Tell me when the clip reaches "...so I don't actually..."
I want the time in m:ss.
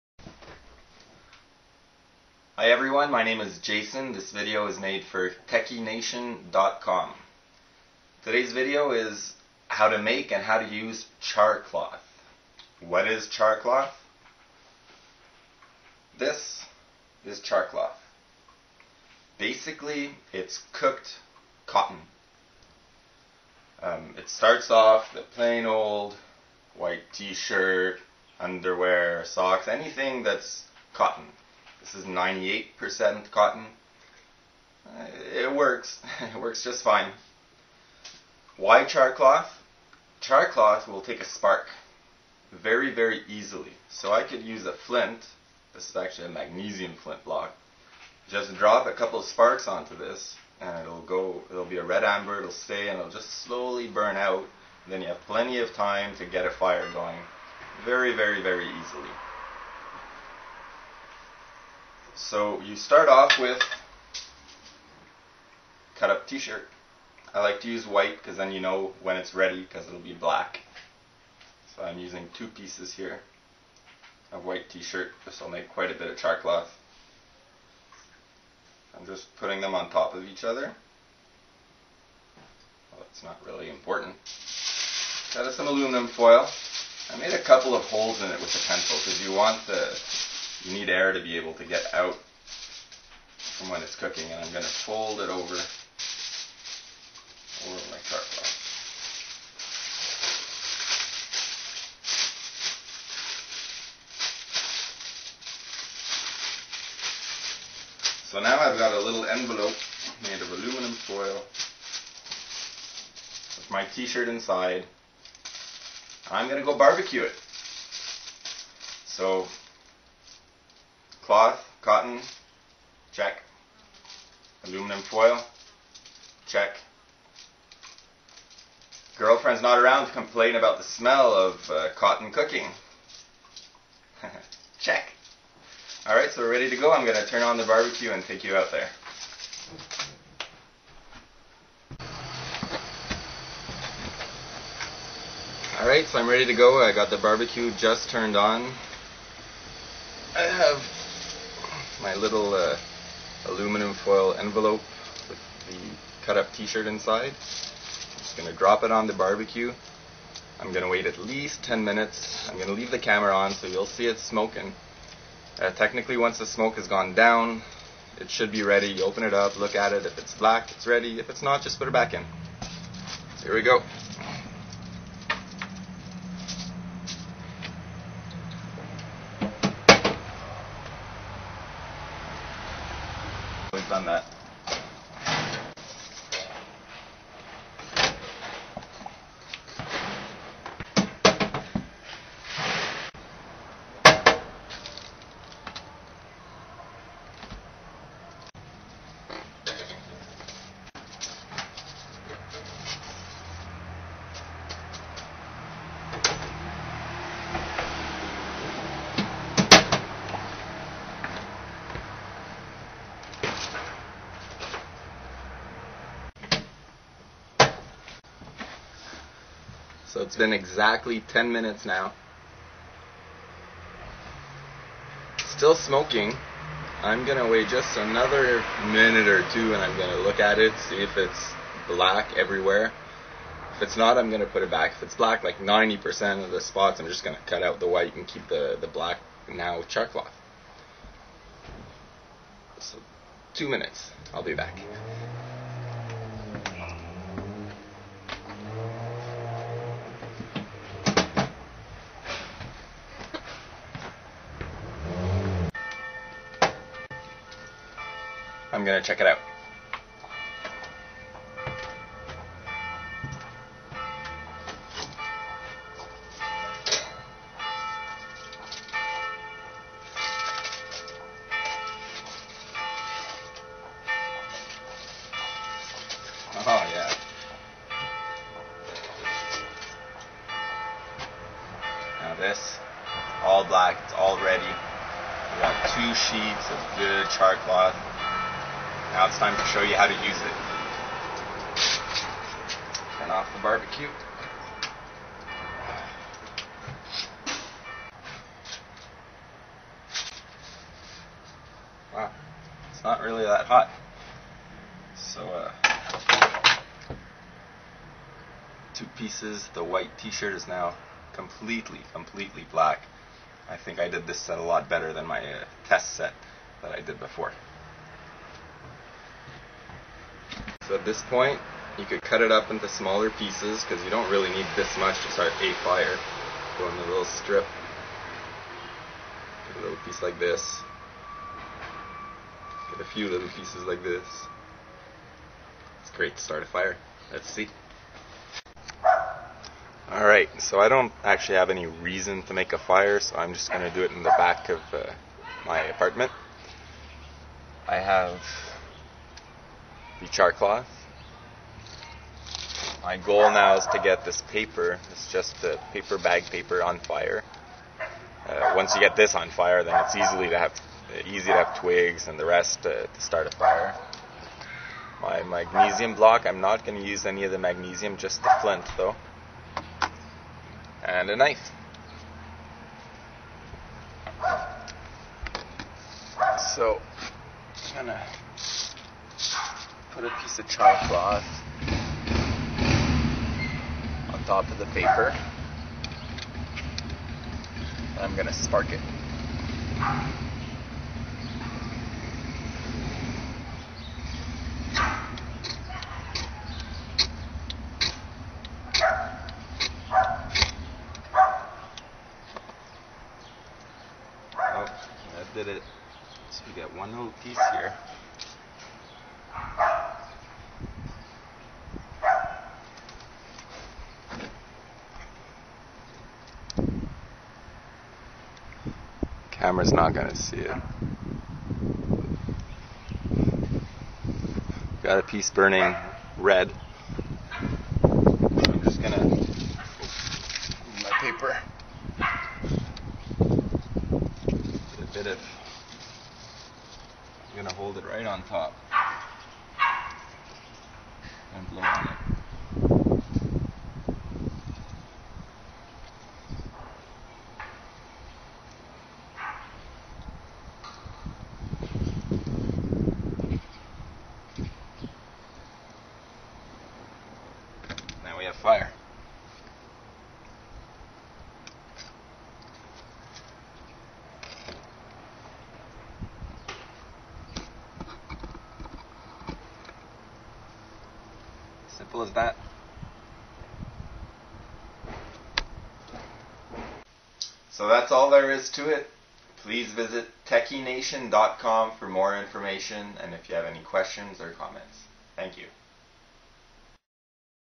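5:40.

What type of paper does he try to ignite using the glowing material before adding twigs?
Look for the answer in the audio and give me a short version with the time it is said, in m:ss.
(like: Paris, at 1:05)
Paper bag paper, at 5:55.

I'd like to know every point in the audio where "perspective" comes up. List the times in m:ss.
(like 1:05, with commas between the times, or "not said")
not said.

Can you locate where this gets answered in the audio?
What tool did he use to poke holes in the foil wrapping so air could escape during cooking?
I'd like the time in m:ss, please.
1:28.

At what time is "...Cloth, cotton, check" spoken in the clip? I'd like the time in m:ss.
2:01.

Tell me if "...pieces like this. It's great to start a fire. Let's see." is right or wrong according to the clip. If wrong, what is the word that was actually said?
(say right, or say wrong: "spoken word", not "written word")
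right.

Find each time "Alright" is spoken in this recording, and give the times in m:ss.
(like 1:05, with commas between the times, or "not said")
2:16, 2:25, 5:40.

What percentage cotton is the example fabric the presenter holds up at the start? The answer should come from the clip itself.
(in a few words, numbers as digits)
98%.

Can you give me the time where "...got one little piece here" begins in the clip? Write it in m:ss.
6:46.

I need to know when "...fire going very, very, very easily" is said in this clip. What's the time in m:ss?
0:56.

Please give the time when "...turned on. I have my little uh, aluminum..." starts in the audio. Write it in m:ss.
2:28.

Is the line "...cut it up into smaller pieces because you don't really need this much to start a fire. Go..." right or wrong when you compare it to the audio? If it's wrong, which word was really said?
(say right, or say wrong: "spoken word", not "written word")
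right.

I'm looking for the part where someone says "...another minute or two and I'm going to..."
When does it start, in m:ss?
3:47.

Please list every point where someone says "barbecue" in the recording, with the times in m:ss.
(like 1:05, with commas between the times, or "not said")
1:56, 2:17, 2:27, 2:39, 4:53.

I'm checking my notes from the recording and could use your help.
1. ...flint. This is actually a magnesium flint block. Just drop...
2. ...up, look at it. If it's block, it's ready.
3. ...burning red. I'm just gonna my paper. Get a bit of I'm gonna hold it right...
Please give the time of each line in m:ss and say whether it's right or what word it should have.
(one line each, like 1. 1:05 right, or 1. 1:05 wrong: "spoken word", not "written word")
1. 0:44 right
2. 2:49 wrong: "black", not "block"
3. 7:05 right.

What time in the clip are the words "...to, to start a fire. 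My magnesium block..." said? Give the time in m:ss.
6:02.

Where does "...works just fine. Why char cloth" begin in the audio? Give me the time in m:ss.
0:36.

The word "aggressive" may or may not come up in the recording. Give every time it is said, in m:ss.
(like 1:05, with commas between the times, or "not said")
not said.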